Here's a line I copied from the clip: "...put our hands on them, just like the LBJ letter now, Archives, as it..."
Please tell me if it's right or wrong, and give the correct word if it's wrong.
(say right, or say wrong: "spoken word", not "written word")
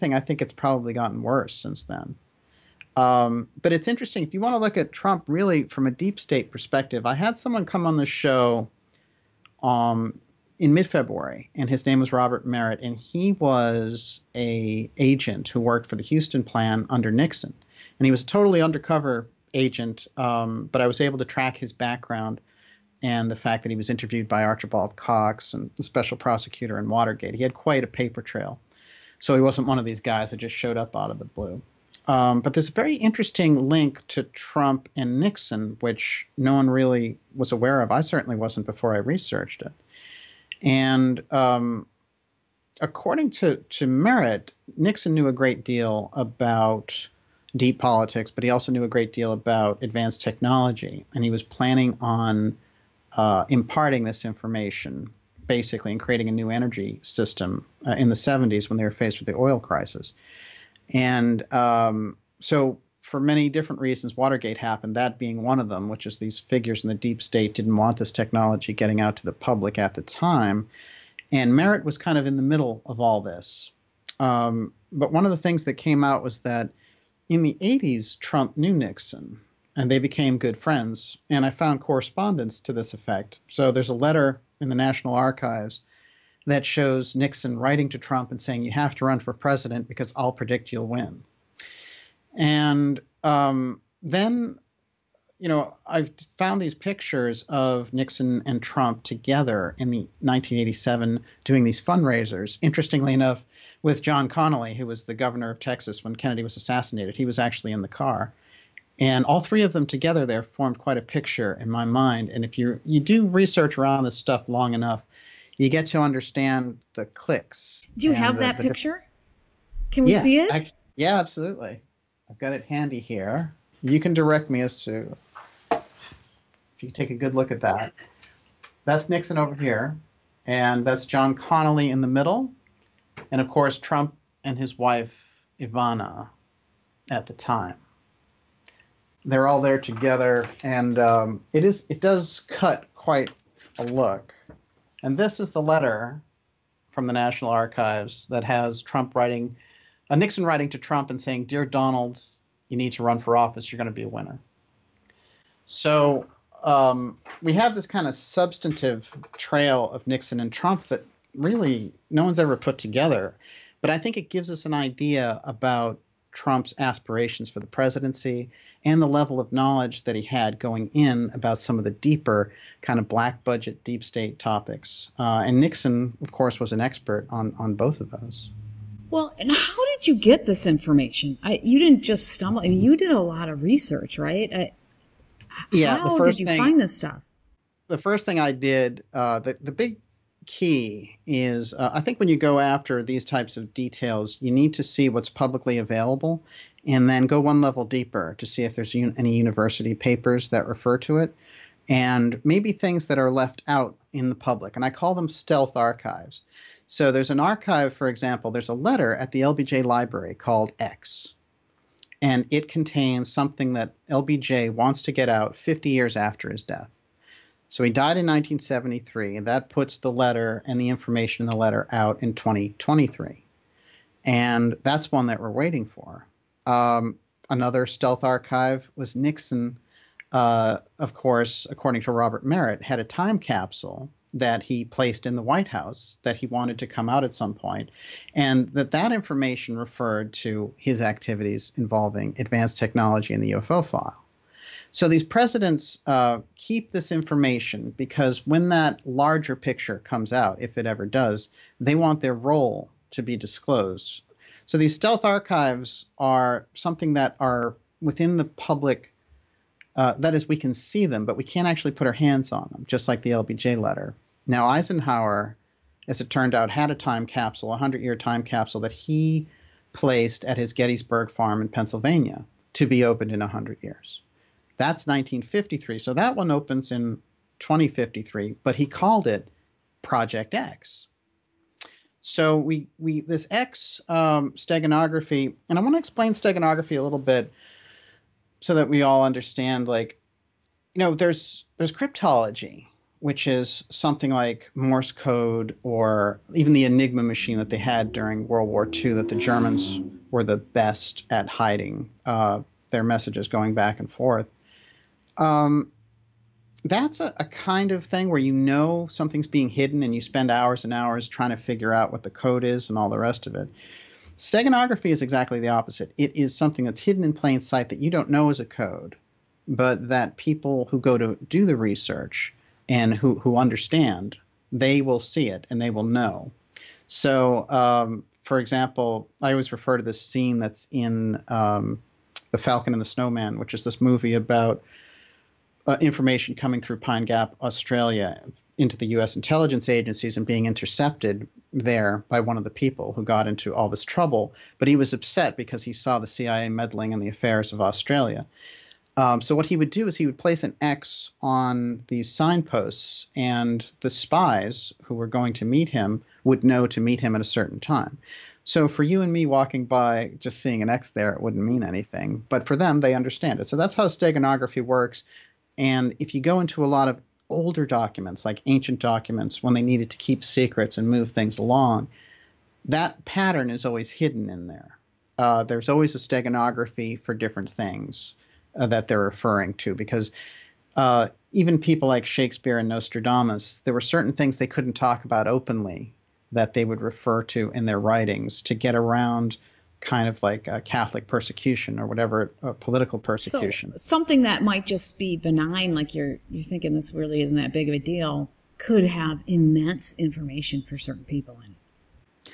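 wrong: "Eisenhower", not "Archives".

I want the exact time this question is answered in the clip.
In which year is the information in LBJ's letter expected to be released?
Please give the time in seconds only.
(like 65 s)
222 s.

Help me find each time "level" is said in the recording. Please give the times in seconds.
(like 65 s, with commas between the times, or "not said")
169 s, 197 s.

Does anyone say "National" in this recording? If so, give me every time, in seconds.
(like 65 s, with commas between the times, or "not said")
84 s, 147 s.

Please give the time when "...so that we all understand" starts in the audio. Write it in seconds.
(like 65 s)
288 s.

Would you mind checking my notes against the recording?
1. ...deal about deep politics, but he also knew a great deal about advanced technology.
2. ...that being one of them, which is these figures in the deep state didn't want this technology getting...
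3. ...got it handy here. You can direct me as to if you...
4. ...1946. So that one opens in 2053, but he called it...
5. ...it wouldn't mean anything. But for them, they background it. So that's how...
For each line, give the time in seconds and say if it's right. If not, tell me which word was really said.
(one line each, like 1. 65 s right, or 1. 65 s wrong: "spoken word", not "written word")
1. 45 s right
2. 64 s right
3. 122 s right
4. 275 s wrong: "1953", not "1946"
5. 361 s wrong: "understand", not "background".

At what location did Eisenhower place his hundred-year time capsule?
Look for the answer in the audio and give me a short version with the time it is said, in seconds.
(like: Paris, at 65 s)
Gettysburg farm, at 270 s.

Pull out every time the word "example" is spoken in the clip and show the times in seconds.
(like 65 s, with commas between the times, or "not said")
208 s, 328 s.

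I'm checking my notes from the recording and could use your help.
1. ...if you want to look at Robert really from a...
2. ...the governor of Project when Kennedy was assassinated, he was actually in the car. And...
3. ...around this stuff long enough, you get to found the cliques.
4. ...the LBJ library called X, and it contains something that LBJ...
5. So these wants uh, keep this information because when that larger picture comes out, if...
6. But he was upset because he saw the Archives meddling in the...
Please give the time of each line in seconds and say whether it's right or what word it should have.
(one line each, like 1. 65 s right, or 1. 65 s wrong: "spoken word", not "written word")
1. 4 s wrong: "Trump", not "Robert"
2. 105 s wrong: "Texas", not "Project"
3. 113 s wrong: "understand", not "found"
4. 209 s right
5. 244 s wrong: "presidents", not "wants"
6. 344 s wrong: "CIA", not "Archives".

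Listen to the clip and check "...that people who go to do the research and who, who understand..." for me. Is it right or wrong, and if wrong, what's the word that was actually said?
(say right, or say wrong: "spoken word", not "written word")
right.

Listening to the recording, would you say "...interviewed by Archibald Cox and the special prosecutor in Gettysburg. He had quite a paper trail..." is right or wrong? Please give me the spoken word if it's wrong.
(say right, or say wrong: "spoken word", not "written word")
wrong: "Watergate", not "Gettysburg".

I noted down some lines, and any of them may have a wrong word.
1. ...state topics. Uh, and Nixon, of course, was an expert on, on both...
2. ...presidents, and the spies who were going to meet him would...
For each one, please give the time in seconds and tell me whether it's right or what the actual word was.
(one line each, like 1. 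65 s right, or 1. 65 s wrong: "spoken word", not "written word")
1. 174 s right
2. 352 s wrong: "signposts", not "presidents".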